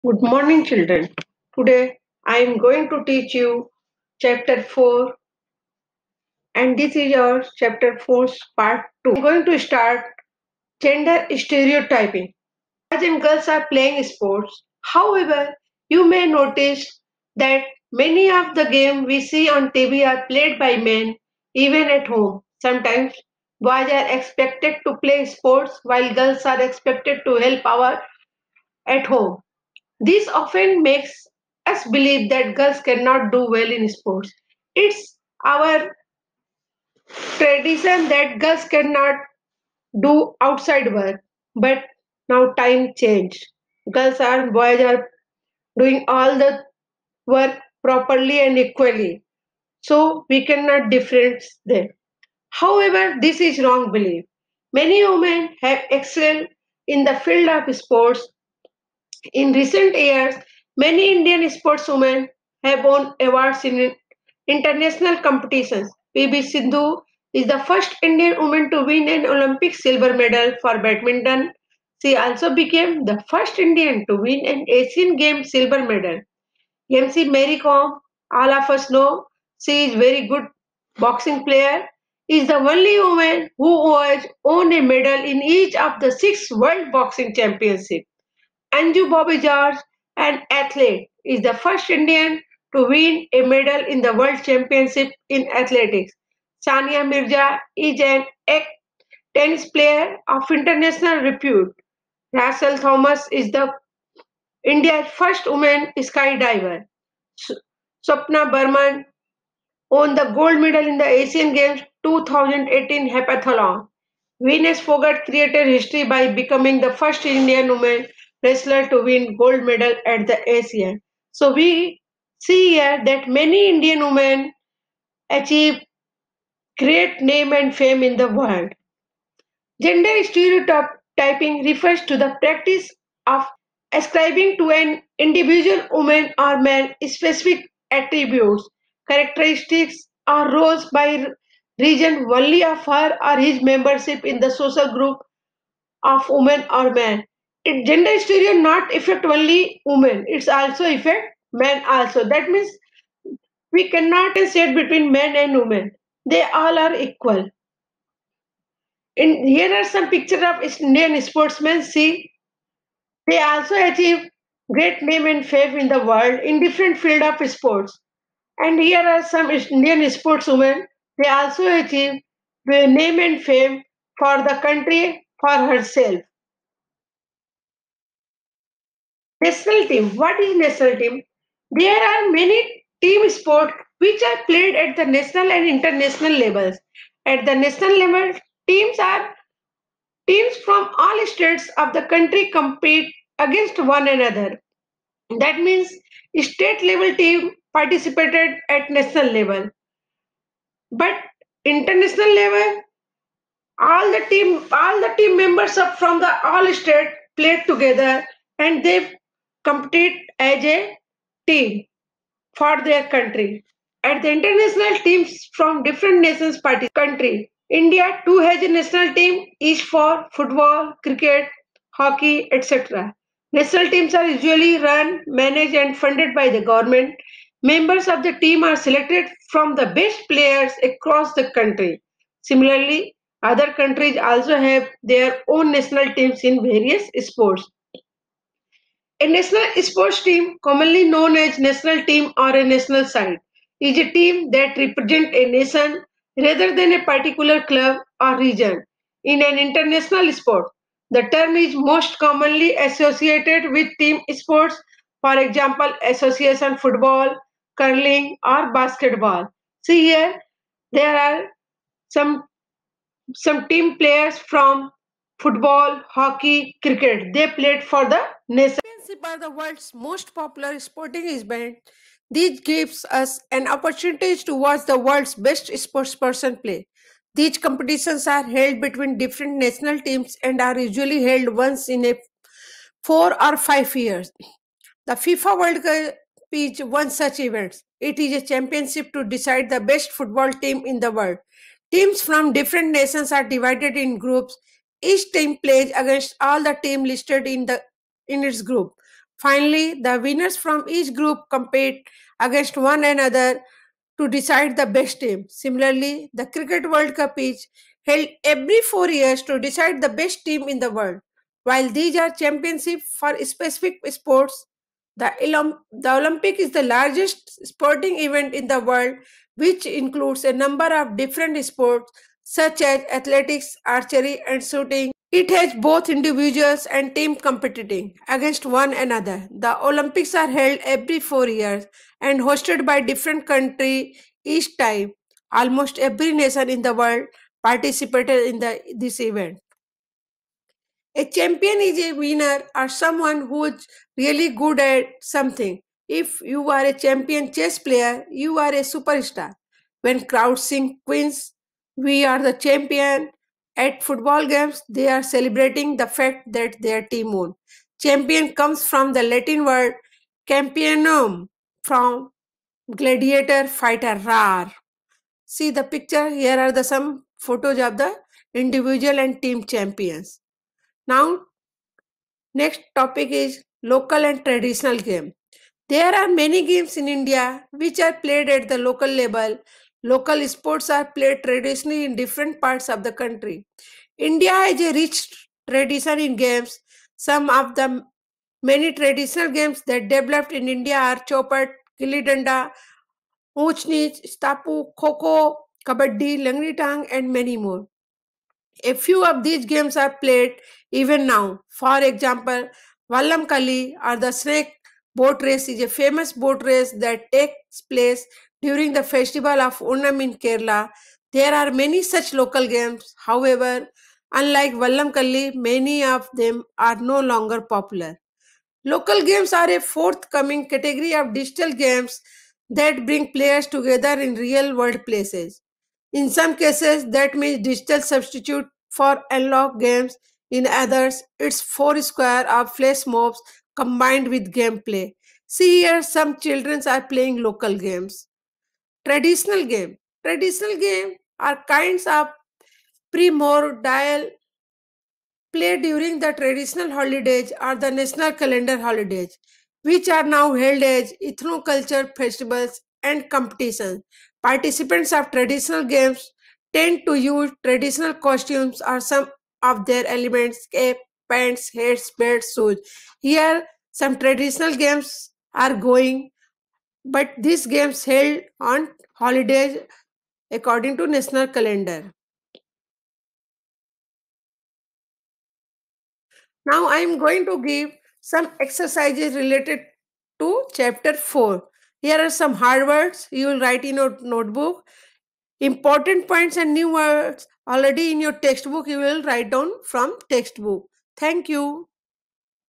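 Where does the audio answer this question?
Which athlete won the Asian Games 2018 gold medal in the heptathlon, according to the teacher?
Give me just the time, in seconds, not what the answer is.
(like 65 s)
108 s.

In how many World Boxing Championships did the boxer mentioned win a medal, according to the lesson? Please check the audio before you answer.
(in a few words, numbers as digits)
6.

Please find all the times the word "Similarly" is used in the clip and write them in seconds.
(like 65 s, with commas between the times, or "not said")
232 s, 305 s.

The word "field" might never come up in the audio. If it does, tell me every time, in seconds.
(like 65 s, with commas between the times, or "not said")
57 s, 166 s.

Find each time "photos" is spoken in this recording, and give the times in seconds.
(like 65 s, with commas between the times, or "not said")
367 s.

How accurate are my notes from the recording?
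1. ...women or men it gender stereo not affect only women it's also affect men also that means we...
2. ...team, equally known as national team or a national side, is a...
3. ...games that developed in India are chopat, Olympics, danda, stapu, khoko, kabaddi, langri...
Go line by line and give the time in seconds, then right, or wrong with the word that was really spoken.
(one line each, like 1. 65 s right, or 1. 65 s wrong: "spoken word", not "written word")
1. 146 s right
2. 240 s wrong: "commonly", not "equally"
3. 389 s wrong: "Kilidanda", not "Olympics".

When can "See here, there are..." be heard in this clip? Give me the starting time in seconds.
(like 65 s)
259 s.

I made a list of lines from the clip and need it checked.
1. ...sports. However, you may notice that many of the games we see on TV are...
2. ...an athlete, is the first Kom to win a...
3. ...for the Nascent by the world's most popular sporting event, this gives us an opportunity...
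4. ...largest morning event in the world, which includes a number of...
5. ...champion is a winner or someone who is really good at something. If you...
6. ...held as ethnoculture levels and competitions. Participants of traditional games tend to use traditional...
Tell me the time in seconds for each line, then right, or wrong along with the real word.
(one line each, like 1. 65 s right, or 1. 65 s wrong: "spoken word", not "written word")
1. 14 s right
2. 90 s wrong: "Indian", not "Kom"
3. 267 s right
4. 316 s wrong: "sporting", not "morning"
5. 341 s right
6. 450 s wrong: "festivals", not "levels".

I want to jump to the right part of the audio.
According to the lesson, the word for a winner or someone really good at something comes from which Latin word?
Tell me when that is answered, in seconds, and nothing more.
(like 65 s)
360 s.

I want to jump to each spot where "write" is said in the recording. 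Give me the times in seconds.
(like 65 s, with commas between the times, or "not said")
483 s, 489 s.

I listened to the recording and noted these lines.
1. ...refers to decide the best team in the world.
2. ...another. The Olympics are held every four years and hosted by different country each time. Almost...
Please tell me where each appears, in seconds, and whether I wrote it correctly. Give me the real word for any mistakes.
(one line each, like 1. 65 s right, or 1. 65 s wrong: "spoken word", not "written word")
1. 309 s wrong: "years", not "refers"
2. 328 s right.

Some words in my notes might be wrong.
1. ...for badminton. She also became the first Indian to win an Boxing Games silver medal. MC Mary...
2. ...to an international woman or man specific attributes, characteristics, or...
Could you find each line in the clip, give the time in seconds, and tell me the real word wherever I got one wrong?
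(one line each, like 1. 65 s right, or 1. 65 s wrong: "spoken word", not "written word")
1. 70 s wrong: "Asian", not "Boxing"
2. 134 s wrong: "individual", not "international".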